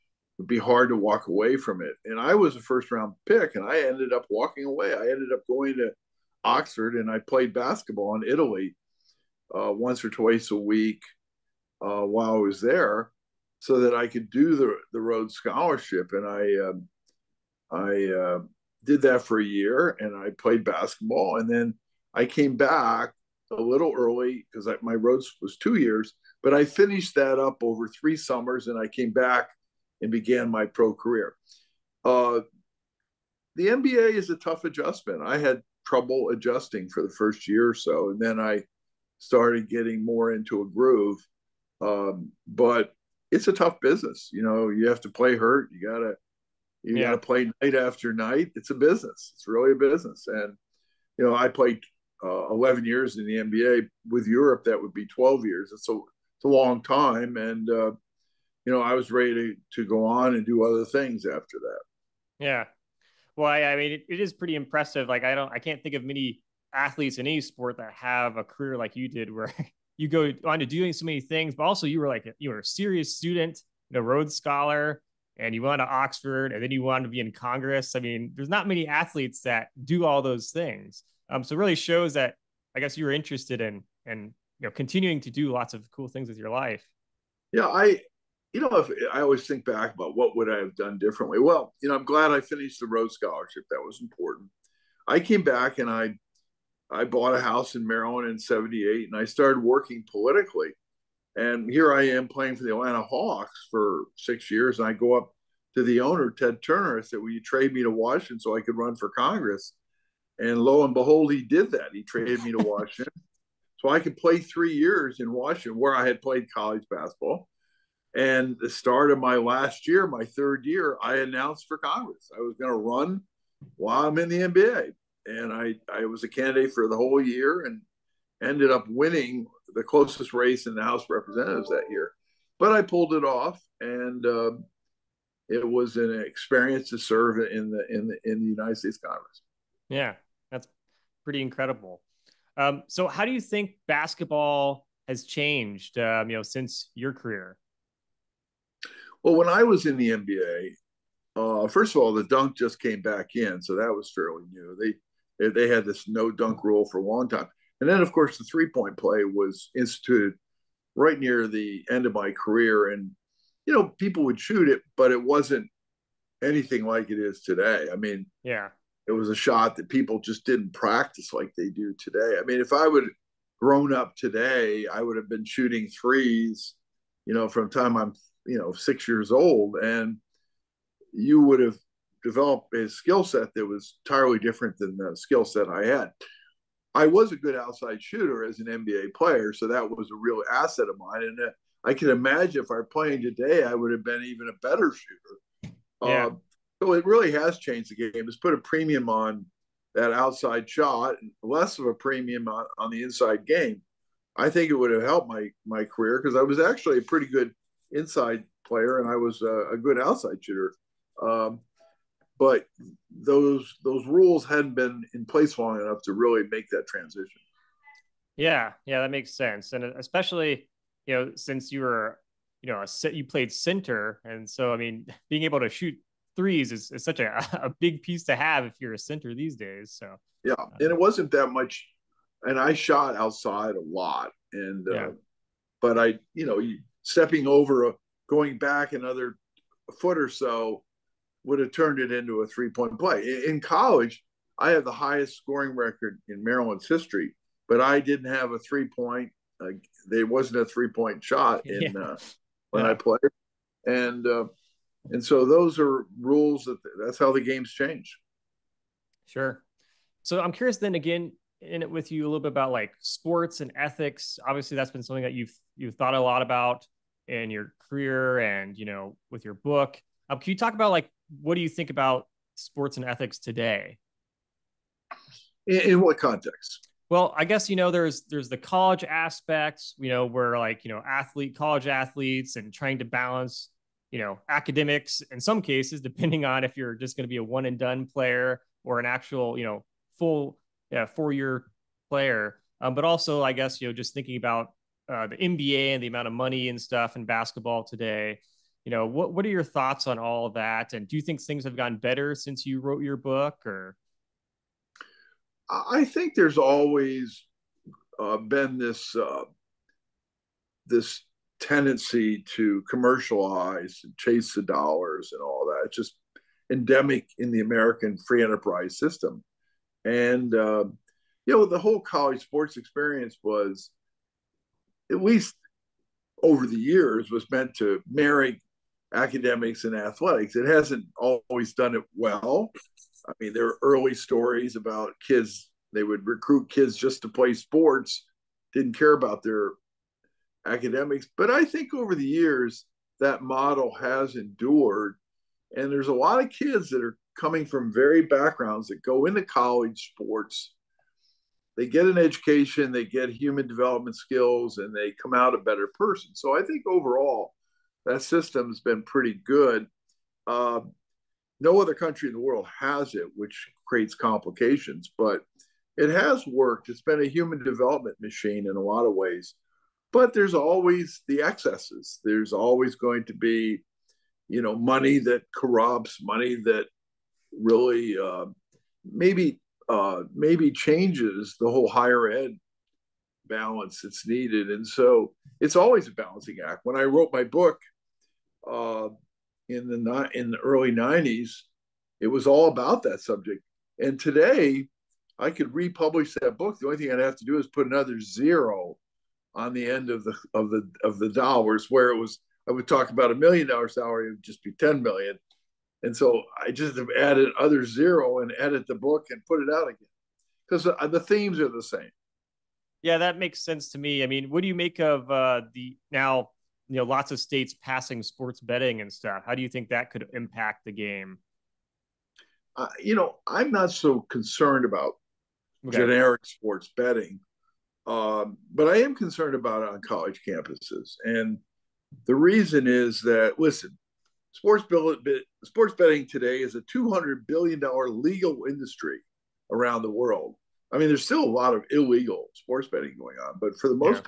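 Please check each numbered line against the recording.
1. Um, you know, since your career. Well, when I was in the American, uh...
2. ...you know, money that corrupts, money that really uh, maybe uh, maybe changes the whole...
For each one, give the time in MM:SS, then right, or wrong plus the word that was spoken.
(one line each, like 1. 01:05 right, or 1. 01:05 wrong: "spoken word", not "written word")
1. 02:25 wrong: "NBA", not "American"
2. 06:14 right.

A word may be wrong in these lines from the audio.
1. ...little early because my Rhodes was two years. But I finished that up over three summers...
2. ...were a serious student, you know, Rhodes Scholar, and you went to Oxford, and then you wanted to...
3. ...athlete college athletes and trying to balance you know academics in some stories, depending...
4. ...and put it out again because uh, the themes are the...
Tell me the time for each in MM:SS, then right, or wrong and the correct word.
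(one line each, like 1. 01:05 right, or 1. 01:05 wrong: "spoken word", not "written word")
1. 00:23 right
2. 01:12 right
3. 04:41 wrong: "cases", not "stories"
4. 06:49 right.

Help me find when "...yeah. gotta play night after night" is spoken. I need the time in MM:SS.
00:46.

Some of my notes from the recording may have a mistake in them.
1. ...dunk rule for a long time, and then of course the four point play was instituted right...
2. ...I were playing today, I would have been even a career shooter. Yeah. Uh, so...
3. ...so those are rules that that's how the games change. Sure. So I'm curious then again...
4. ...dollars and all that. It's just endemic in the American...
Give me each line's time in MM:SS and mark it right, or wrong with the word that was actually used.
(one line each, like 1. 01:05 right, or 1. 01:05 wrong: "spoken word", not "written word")
1. 02:36 wrong: "three", not "four"
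2. 03:12 wrong: "better", not "career"
3. 04:15 right
4. 05:14 right.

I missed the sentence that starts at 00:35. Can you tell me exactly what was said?
I had trouble adjusting for the first year or so, and then I started getting more into a groove.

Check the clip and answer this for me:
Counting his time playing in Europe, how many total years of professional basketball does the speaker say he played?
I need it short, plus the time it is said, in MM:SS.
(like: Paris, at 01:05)
12, at 00:55.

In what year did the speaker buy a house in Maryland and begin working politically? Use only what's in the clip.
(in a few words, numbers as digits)
1978.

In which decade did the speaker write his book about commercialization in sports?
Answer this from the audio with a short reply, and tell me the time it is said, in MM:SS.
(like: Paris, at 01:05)
1990s, at 06:30.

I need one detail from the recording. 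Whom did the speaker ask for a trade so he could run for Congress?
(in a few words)
Ted Turner.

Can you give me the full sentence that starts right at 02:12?
But I pulled it off, and uh, it was an experience to serve in the in the in the United States Congress.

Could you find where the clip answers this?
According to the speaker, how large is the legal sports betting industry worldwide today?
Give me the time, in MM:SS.
07:16.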